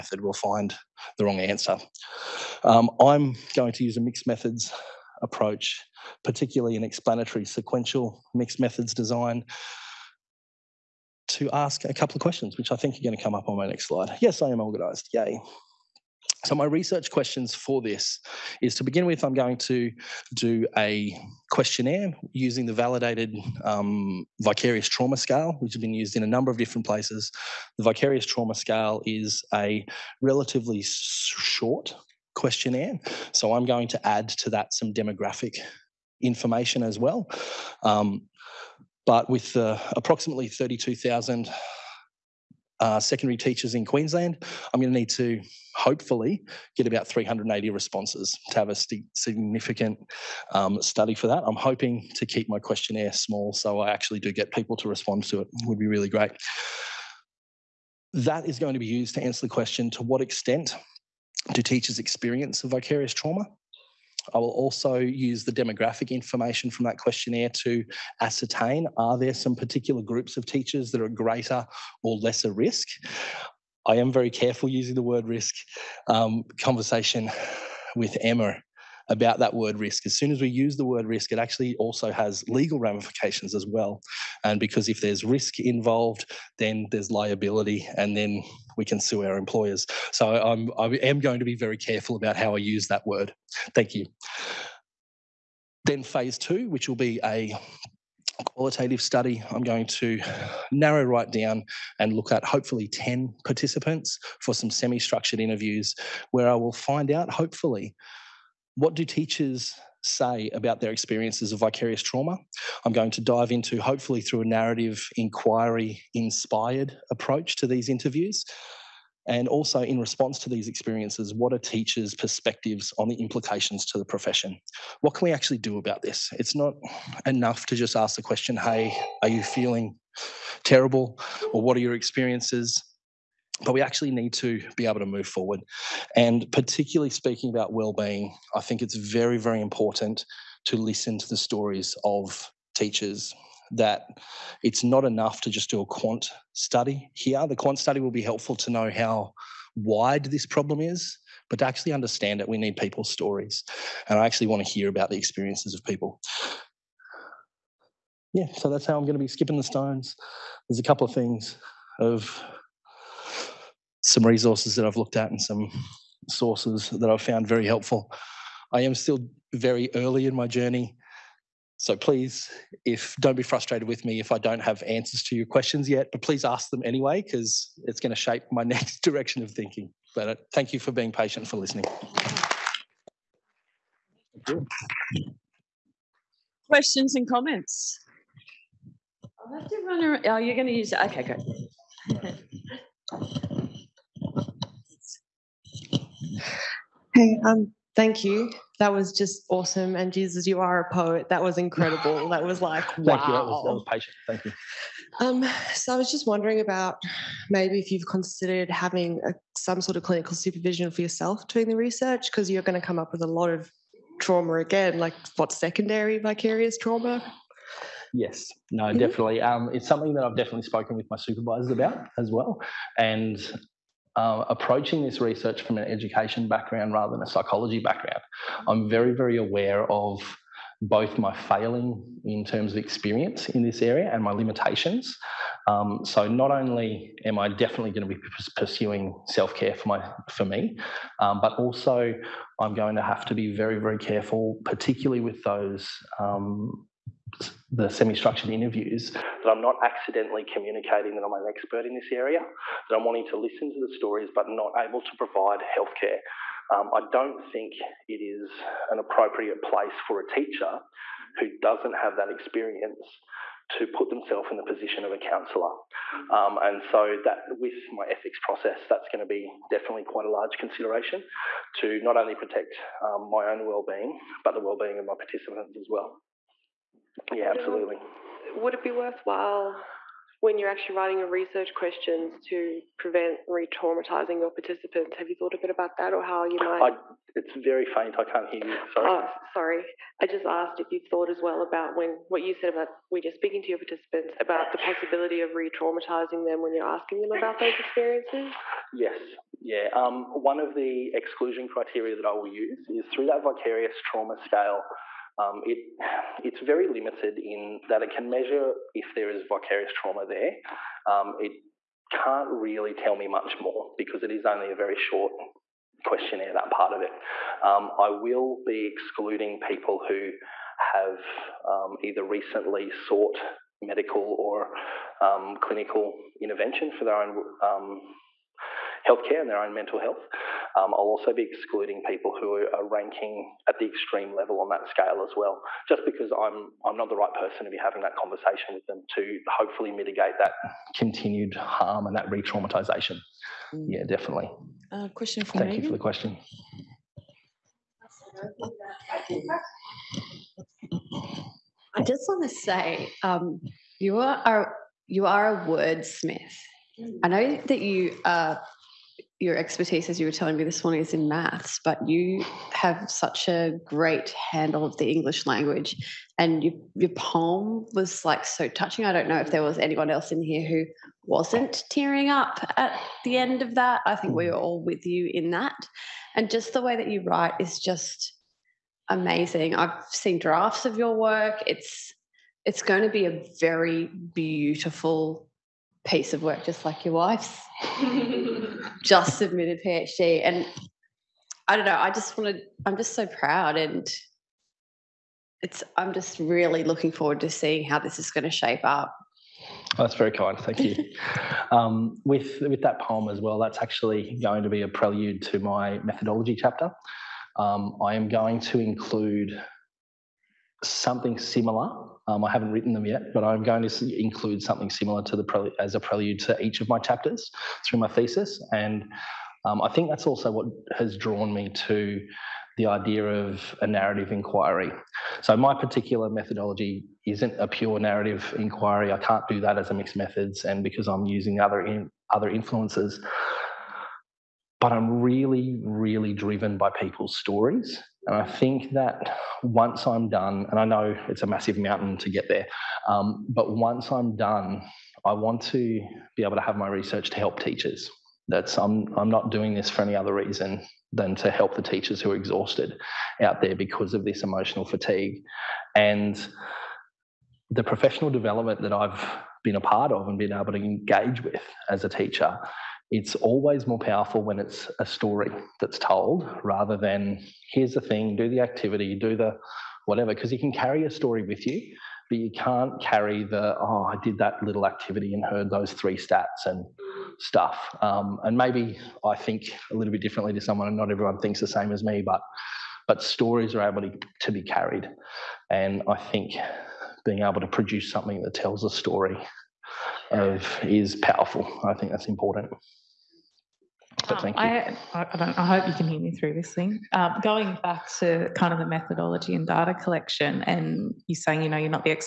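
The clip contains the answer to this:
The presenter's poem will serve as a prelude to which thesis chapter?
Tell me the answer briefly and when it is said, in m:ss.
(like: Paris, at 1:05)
methodology chapter, at 6:45.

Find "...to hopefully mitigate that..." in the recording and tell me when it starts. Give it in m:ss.
5:39.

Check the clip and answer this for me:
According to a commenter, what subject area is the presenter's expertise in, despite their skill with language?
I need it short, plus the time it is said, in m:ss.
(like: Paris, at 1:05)
maths, at 6:01.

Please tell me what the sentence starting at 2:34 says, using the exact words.
And I actually want to hear about the experiences of people.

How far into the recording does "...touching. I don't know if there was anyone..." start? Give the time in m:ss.
6:08.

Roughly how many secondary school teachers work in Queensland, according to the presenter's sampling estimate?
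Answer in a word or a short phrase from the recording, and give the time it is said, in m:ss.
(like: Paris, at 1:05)
32,000, at 0:40.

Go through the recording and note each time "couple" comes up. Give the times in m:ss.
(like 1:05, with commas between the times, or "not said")
0:11, 2:40.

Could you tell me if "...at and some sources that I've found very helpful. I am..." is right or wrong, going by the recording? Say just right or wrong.
right.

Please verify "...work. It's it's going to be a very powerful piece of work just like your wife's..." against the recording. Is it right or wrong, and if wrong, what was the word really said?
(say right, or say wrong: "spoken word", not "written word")
wrong: "beautiful", not "powerful".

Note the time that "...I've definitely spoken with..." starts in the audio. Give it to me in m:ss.
3:40.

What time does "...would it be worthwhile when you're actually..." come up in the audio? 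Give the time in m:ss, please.
4:38.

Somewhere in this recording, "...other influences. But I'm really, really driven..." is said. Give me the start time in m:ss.
7:12.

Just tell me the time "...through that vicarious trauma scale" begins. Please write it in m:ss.
5:03.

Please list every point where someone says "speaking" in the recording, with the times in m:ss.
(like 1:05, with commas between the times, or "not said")
2:17, 4:53.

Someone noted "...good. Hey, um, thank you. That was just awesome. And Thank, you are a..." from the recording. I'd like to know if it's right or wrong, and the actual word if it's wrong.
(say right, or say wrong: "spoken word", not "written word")
wrong: "Jesus", not "Thank".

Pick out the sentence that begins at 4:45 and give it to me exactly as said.
Have you thought a bit about that, or how you might?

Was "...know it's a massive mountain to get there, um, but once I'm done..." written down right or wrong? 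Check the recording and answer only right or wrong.
right.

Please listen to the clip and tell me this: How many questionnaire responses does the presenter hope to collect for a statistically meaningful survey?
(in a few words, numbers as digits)
380.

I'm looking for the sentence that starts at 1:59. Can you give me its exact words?
And also, in response to these experiences, what are teachers' perspectives on the implications to the profession?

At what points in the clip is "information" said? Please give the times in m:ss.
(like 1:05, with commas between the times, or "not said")
0:36, 1:06.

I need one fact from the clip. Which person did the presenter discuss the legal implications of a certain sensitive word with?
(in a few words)
Emma.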